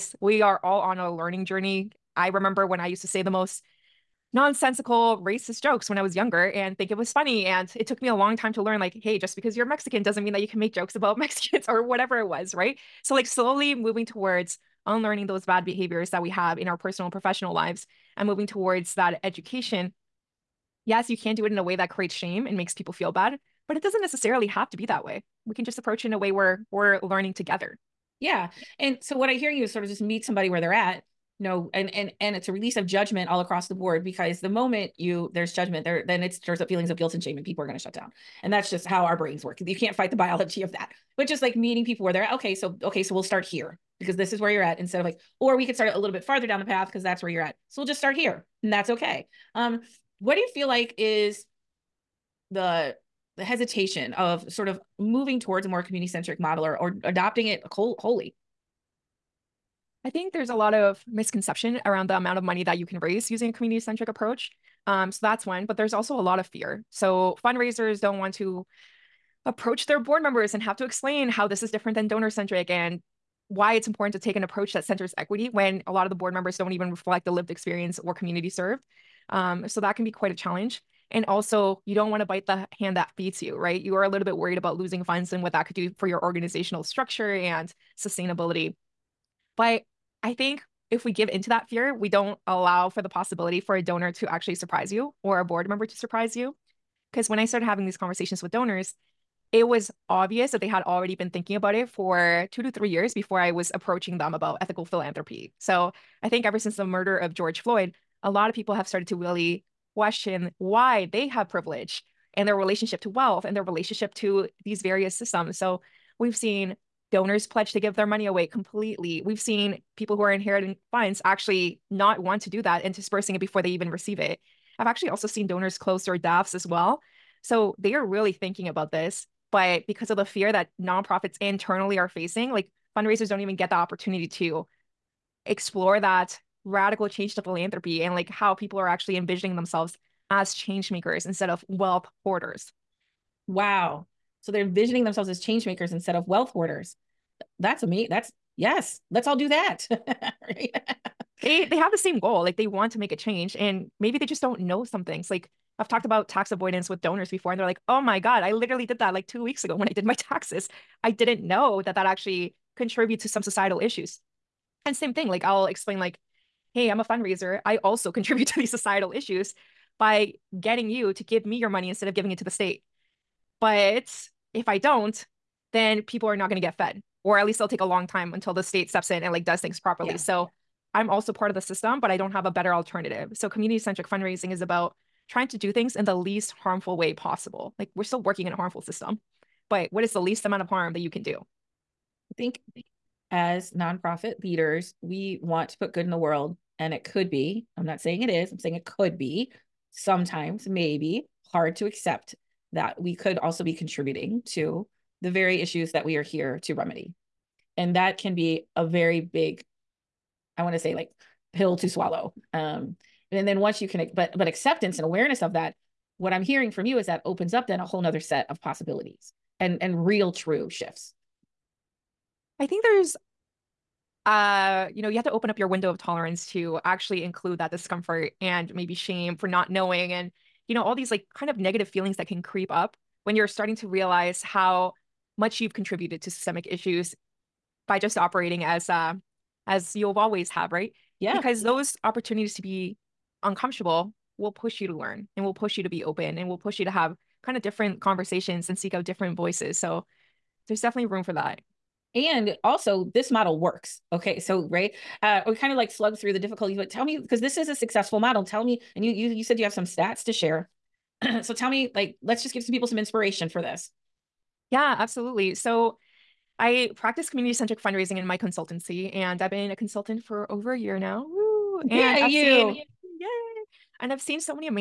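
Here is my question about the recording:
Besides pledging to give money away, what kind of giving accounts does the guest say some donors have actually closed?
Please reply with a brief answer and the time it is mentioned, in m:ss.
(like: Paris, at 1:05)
DAFs, at 2:06.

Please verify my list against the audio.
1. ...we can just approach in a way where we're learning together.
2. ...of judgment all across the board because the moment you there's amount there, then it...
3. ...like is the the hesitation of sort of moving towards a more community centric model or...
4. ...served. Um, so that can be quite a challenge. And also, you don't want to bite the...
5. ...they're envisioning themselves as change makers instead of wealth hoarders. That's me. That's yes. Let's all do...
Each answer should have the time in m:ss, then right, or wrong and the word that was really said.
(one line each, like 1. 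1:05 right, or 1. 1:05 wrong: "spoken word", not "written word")
1. 0:25 right
2. 0:32 wrong: "judgment", not "amount"
3. 0:50 right
4. 1:18 right
5. 2:24 right.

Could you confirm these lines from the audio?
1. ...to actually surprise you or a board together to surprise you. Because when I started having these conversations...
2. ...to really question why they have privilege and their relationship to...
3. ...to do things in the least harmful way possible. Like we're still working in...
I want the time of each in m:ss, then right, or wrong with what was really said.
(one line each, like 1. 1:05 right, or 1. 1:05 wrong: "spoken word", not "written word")
1. 1:34 wrong: "member", not "together"
2. 1:49 right
3. 3:05 right.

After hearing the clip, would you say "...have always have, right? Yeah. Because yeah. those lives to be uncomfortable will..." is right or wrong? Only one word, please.
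wrong.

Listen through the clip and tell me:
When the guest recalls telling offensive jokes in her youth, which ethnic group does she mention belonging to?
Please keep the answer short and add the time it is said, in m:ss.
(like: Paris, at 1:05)
Mexican, at 0:09.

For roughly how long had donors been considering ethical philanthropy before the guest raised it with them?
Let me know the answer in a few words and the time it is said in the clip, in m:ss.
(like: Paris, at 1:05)
2 to 3 years, at 1:42.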